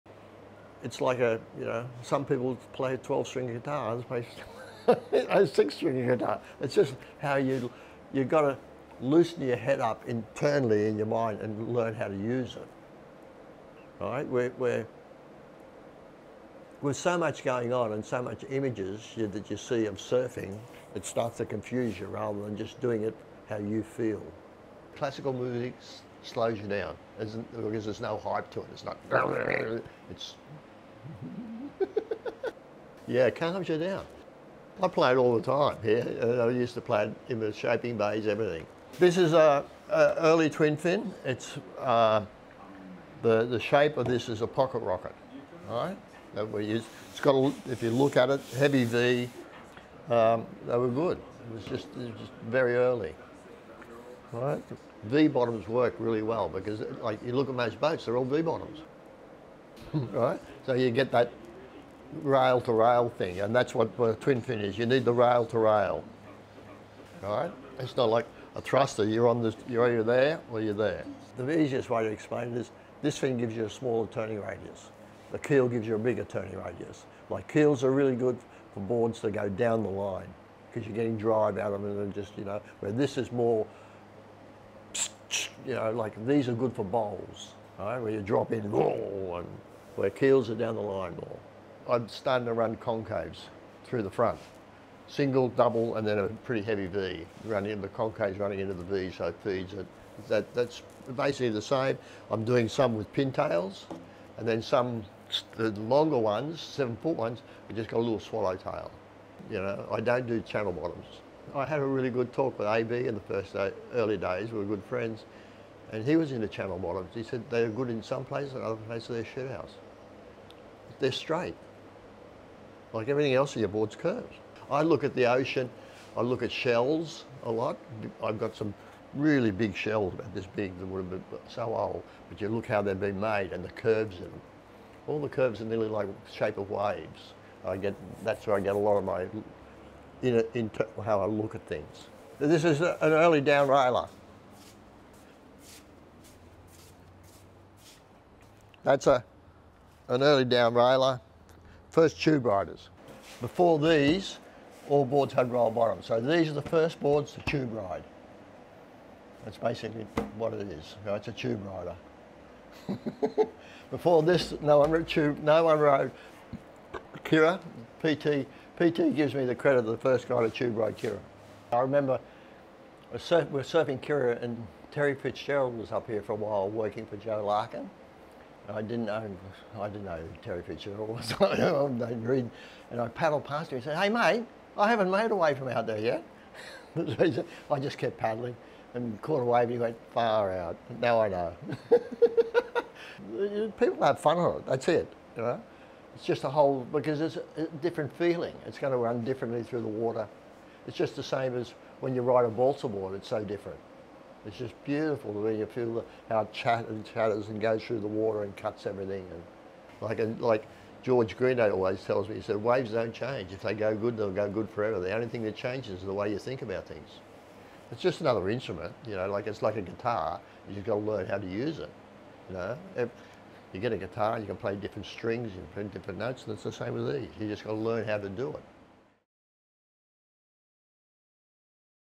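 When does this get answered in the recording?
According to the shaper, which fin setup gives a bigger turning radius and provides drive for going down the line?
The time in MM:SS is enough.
01:15.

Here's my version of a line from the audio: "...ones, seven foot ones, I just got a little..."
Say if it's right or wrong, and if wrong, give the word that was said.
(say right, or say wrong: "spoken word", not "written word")
right.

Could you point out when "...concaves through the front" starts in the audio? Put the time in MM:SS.
01:32.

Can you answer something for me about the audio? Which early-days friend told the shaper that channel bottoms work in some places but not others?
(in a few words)
AB.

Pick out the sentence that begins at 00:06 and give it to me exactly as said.
It's just how you, you've got to loosen your head up internally in your mind and learn how to use it.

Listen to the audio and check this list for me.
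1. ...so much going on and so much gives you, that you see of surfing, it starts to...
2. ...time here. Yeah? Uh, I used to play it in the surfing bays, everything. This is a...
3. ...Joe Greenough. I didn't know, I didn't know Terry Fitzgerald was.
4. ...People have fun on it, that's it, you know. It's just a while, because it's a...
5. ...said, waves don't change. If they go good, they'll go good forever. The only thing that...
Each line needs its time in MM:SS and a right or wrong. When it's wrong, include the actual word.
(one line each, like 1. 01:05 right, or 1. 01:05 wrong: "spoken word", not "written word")
1. 00:16 wrong: "images", not "gives"
2. 00:35 wrong: "shaping", not "surfing"
3. 02:57 wrong: "Larkin", not "Greenough"
4. 03:13 wrong: "whole", not "while"
5. 03:32 right.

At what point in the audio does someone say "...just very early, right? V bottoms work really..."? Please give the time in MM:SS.
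00:52.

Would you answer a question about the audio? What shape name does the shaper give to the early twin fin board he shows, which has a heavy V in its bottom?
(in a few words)
pocket rocket.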